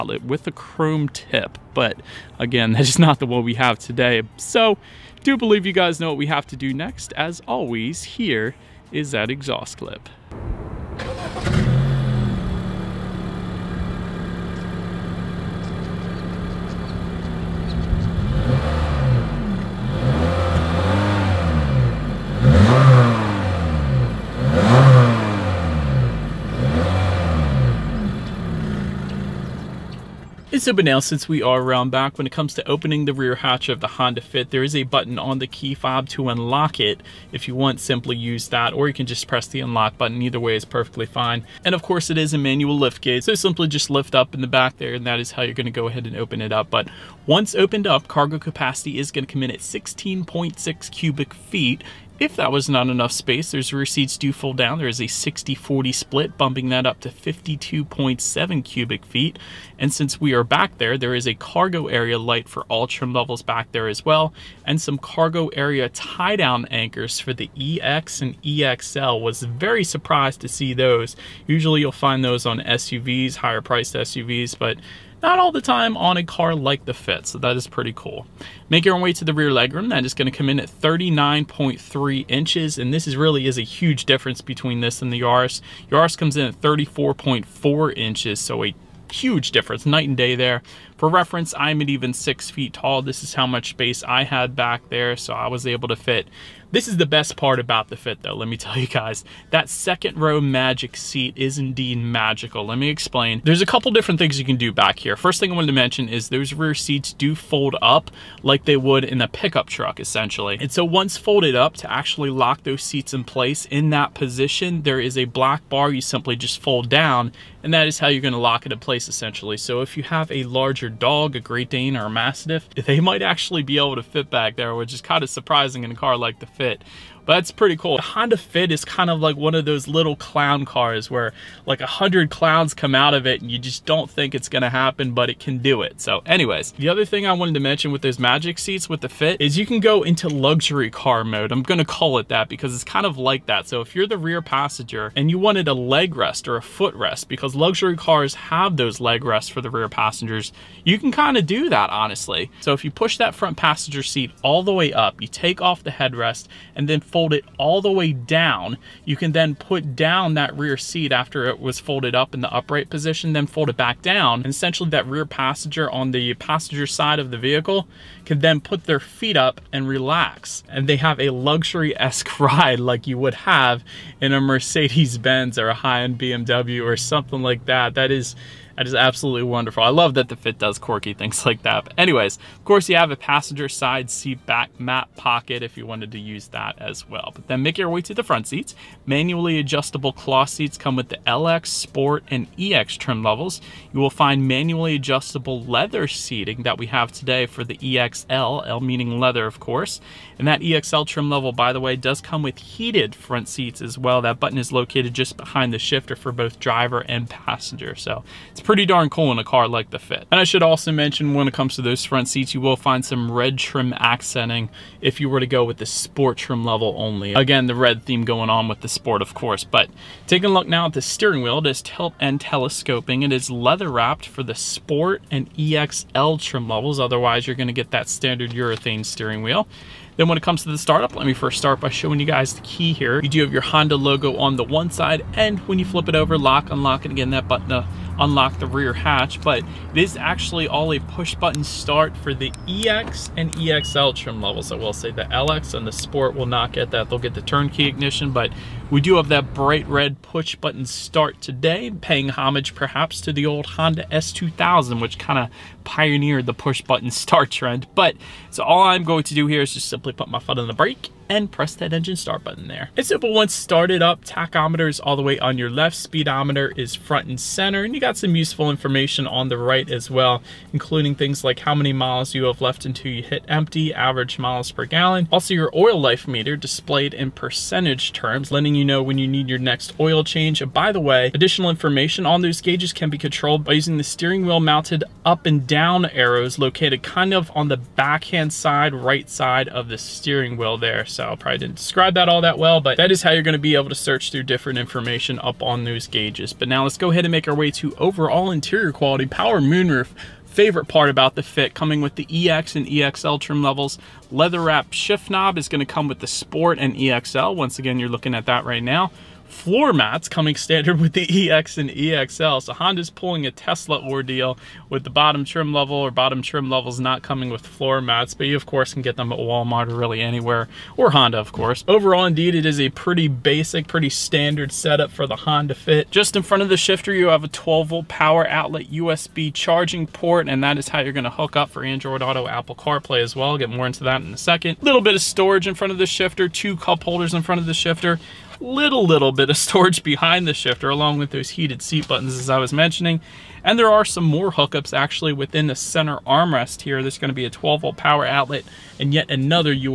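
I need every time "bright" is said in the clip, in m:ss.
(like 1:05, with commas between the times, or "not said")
4:09.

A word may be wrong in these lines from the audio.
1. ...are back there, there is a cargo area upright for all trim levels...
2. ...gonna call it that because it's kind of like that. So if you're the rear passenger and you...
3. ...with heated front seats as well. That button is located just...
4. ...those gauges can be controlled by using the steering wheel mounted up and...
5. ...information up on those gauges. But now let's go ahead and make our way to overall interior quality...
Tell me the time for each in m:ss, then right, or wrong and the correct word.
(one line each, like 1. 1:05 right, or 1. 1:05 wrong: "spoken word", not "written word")
1. 1:00 wrong: "light", not "upright"
2. 2:21 right
3. 3:22 right
4. 4:42 right
5. 4:54 right.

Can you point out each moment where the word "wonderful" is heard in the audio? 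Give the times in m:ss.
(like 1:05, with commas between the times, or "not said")
2:59.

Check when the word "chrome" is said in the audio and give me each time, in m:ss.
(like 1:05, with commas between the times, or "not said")
0:00.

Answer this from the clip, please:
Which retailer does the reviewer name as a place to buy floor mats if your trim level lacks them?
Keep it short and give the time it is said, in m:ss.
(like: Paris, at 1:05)
Walmart, at 5:19.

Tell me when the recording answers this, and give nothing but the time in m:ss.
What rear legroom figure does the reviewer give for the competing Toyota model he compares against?
1:26.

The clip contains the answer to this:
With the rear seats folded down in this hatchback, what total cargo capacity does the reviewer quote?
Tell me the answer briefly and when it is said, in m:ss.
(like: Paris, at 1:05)
52.7 cubic feet, at 0:57.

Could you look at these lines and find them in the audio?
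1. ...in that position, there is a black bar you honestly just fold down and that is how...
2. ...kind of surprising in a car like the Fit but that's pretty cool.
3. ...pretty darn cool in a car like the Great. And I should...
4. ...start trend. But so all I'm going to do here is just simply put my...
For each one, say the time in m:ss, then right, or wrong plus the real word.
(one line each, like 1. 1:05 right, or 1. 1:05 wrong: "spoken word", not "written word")
1. 1:53 wrong: "simply", not "honestly"
2. 2:05 right
3. 3:28 wrong: "Fit", not "Great"
4. 4:17 right.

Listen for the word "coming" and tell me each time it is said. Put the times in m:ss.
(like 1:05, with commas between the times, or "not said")
5:01, 5:10, 5:17.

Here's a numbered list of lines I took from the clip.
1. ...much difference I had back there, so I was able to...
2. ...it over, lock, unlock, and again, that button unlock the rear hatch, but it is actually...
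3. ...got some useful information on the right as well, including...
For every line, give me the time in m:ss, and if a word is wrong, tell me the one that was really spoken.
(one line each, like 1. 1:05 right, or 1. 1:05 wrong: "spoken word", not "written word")
1. 1:33 wrong: "space", not "difference"
2. 3:56 right
3. 4:28 right.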